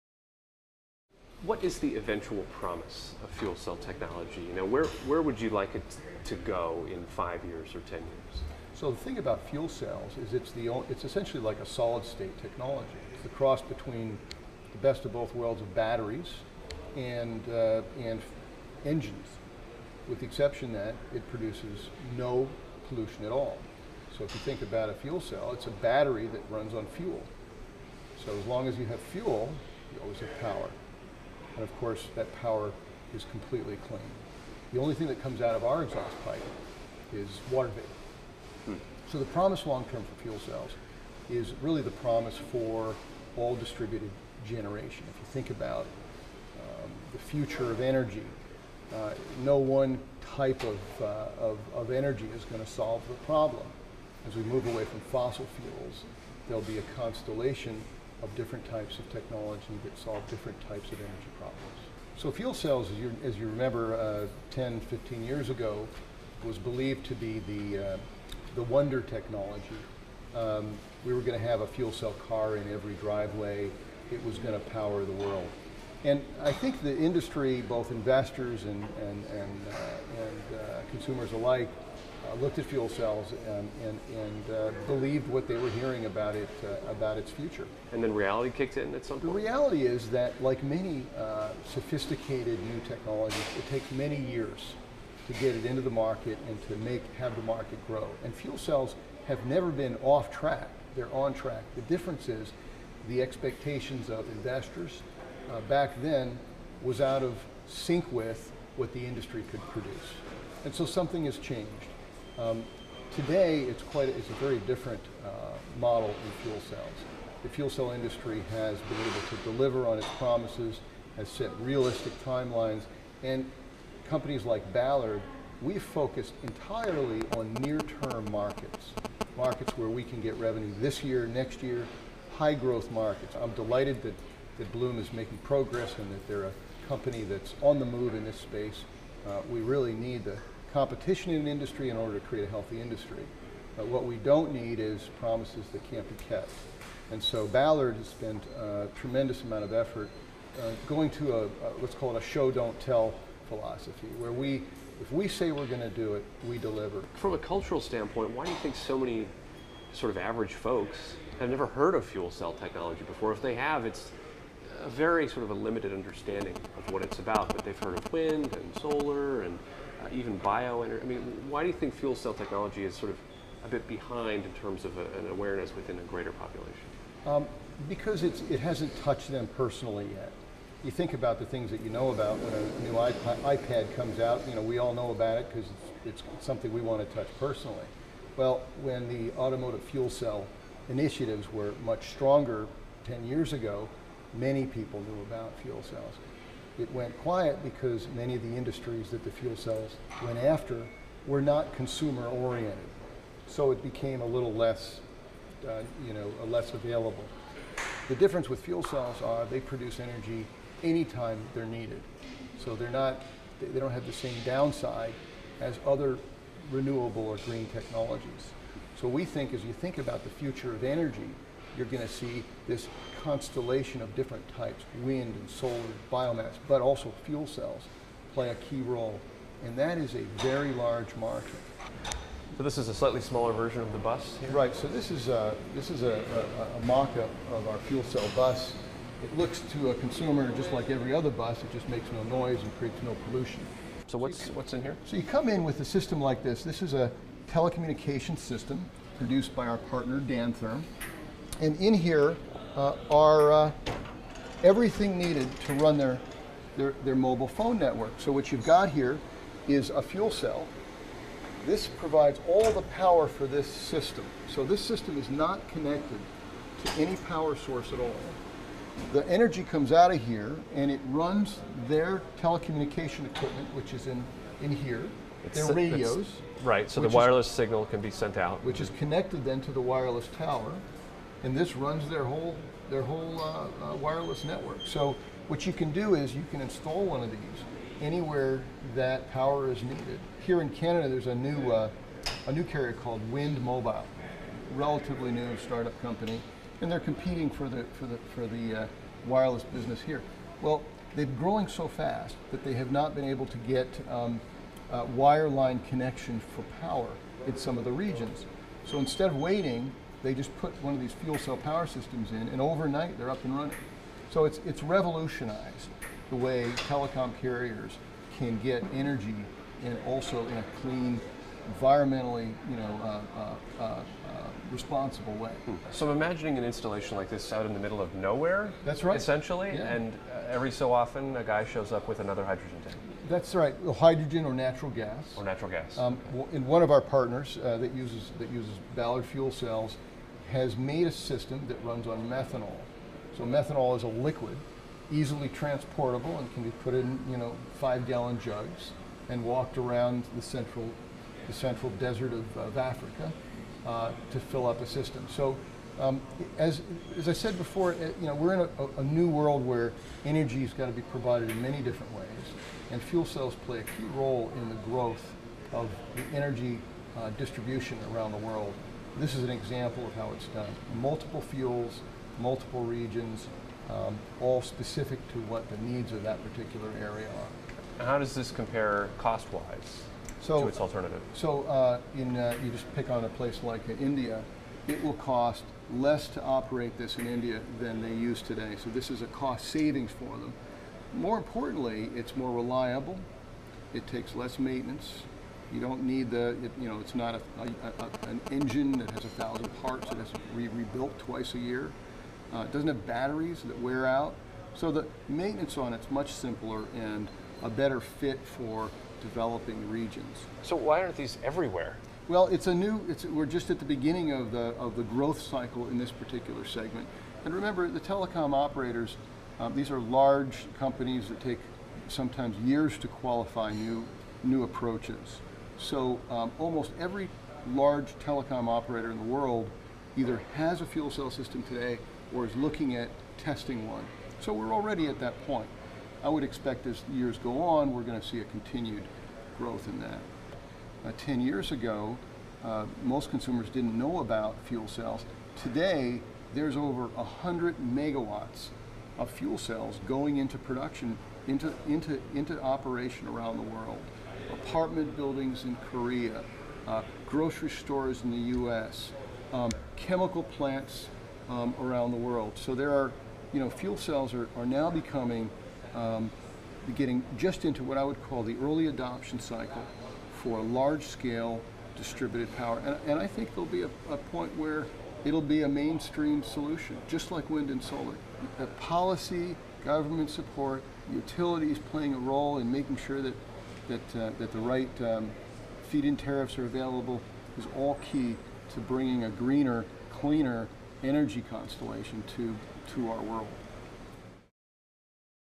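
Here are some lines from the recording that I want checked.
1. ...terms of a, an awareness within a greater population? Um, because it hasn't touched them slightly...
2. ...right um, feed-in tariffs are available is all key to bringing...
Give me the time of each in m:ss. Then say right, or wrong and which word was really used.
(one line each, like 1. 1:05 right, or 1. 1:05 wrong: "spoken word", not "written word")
1. 2:54 wrong: "personally", not "slightly"
2. 8:04 right.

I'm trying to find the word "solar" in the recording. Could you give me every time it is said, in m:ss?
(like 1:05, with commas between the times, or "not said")
2:48, 3:45, 7:57.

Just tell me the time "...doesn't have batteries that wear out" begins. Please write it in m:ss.
6:42.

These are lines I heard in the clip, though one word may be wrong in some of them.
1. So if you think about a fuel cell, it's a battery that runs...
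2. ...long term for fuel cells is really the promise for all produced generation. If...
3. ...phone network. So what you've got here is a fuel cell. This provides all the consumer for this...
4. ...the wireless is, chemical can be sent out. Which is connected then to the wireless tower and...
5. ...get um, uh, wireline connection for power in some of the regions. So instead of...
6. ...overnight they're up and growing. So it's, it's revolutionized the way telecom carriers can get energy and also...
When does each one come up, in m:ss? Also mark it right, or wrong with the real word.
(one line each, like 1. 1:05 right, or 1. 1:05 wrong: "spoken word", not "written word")
1. 0:24 right
2. 0:39 wrong: "distributed", not "produced"
3. 4:17 wrong: "power", not "consumer"
4. 4:37 wrong: "signal", not "chemical"
5. 5:03 right
6. 5:12 wrong: "running", not "growing".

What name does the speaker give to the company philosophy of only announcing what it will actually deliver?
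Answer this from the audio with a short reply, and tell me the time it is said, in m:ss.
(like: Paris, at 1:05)
Show don't tell, at 2:32.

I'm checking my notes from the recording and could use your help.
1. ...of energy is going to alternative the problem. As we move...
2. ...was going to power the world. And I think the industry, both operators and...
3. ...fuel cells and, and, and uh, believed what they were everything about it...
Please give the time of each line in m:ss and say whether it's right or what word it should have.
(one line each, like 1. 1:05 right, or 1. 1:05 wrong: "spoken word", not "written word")
1. 0:51 wrong: "solve", not "alternative"
2. 1:14 wrong: "investors", not "operators"
3. 1:22 wrong: "hearing", not "everything".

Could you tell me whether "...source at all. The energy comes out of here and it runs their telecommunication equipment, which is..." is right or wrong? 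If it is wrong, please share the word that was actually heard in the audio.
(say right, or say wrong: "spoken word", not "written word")
right.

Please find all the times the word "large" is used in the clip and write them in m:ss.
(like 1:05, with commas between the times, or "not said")
3:50, 6:59, 7:07, 7:50.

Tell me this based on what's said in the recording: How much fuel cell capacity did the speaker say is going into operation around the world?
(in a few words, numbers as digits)
Over 100 megawatts.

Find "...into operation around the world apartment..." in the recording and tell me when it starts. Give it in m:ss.
7:32.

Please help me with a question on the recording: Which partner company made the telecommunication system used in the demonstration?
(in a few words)
Dantherm.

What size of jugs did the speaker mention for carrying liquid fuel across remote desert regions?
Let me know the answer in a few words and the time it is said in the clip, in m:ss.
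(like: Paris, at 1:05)
5 gallon, at 5:47.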